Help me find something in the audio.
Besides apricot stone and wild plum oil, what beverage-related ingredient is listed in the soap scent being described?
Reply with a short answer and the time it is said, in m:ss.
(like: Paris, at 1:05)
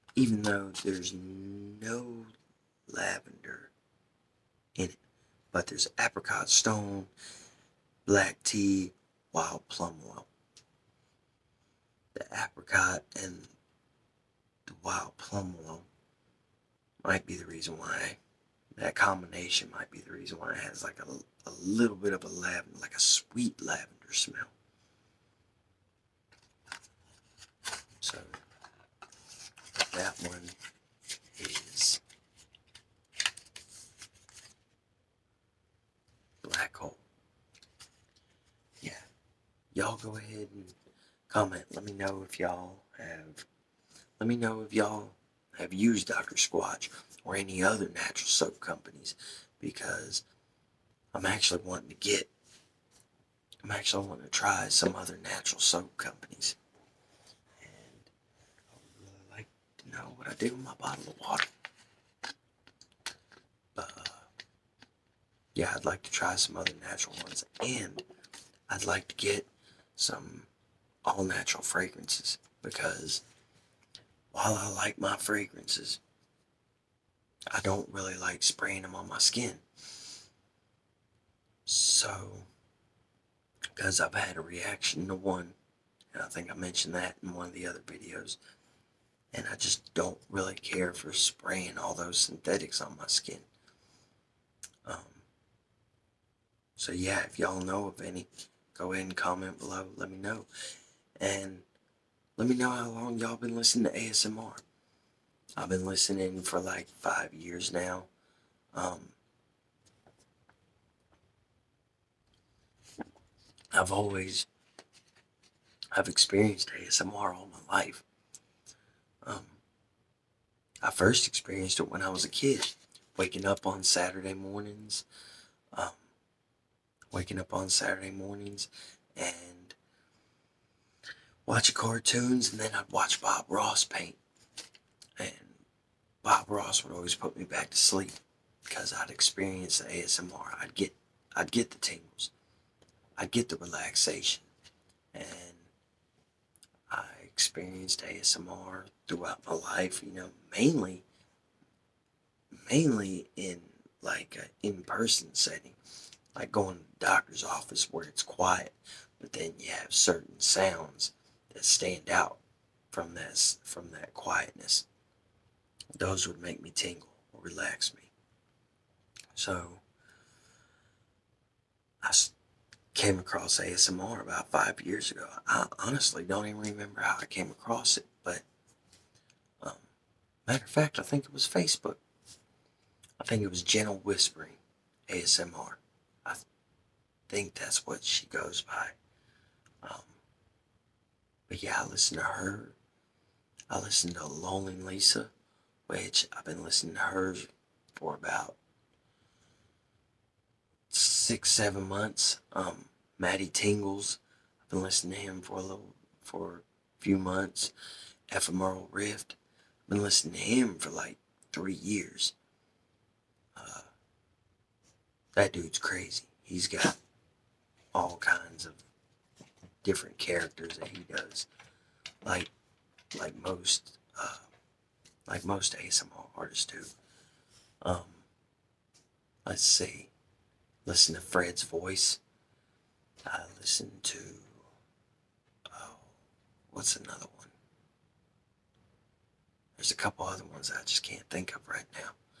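black tea, at 0:08.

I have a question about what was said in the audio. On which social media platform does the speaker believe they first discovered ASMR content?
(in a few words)
Facebook.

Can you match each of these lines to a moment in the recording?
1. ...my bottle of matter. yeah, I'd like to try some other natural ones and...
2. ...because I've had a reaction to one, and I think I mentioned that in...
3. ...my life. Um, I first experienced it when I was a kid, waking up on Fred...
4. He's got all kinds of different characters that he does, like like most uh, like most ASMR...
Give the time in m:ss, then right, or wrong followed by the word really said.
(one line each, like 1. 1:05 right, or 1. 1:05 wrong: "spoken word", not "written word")
1. 1:00 wrong: "water", not "matter"
2. 1:23 right
3. 1:57 wrong: "Saturday", not "Fred"
4. 3:36 right.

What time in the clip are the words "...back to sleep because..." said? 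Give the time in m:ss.
2:17.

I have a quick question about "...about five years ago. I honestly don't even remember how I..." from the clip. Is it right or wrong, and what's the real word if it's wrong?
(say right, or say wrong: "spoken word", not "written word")
right.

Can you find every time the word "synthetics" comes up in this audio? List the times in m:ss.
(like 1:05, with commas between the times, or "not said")
1:32.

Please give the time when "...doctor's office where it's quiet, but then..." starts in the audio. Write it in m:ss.
2:37.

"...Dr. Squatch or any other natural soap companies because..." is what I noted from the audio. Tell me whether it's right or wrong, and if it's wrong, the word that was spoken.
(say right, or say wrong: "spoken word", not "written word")
right.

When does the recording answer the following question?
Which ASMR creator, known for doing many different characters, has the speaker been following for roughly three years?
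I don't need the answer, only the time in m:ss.
3:28.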